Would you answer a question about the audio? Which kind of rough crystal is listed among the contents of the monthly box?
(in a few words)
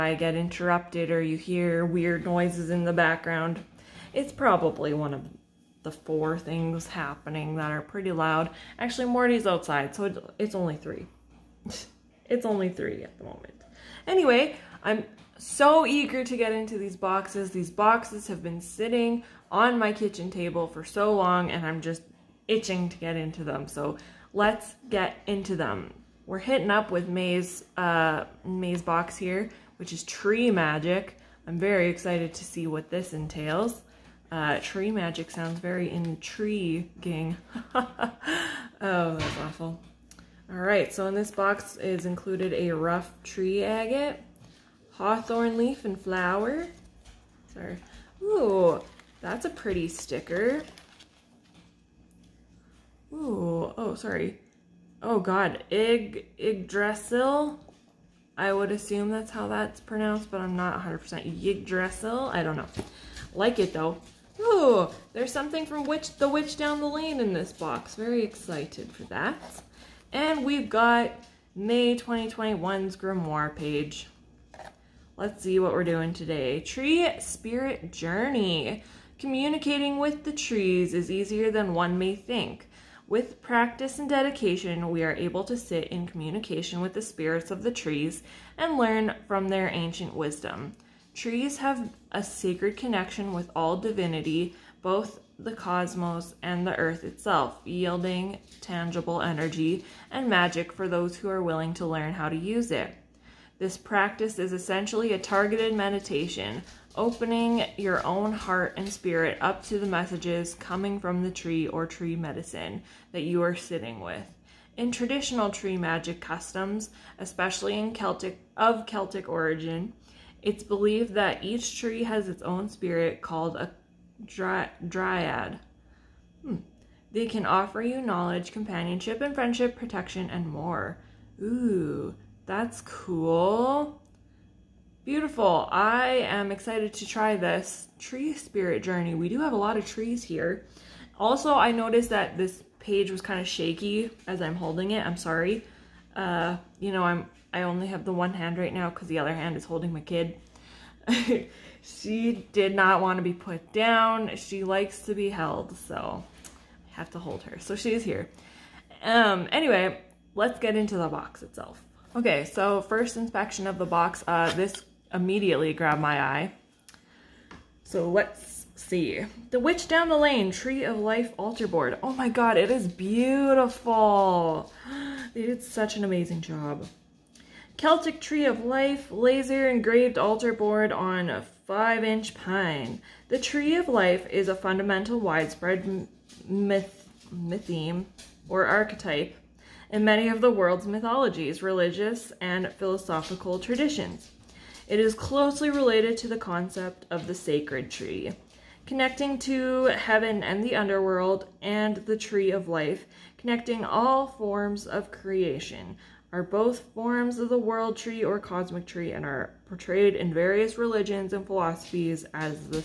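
Tree agate.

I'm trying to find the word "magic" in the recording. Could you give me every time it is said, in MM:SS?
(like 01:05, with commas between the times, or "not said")
00:30, 00:34, 01:40, 01:55.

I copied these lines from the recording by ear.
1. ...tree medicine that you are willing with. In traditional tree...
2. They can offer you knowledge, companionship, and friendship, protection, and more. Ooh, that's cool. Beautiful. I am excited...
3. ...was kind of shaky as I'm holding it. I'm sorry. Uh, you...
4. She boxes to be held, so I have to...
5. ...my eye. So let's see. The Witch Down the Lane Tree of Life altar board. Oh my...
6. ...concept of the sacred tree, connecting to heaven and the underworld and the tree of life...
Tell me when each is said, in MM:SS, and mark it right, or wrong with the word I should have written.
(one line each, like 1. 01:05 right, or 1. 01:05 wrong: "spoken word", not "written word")
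1. 01:51 wrong: "sitting", not "willing"
2. 02:07 right
3. 02:23 right
4. 02:34 wrong: "likes", not "boxes"
5. 02:46 right
6. 03:16 right.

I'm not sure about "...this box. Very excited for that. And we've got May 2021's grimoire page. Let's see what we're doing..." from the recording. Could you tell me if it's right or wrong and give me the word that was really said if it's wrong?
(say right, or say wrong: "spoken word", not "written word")
right.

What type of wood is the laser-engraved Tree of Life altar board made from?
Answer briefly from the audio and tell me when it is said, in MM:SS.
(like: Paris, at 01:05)
Pine, at 03:02.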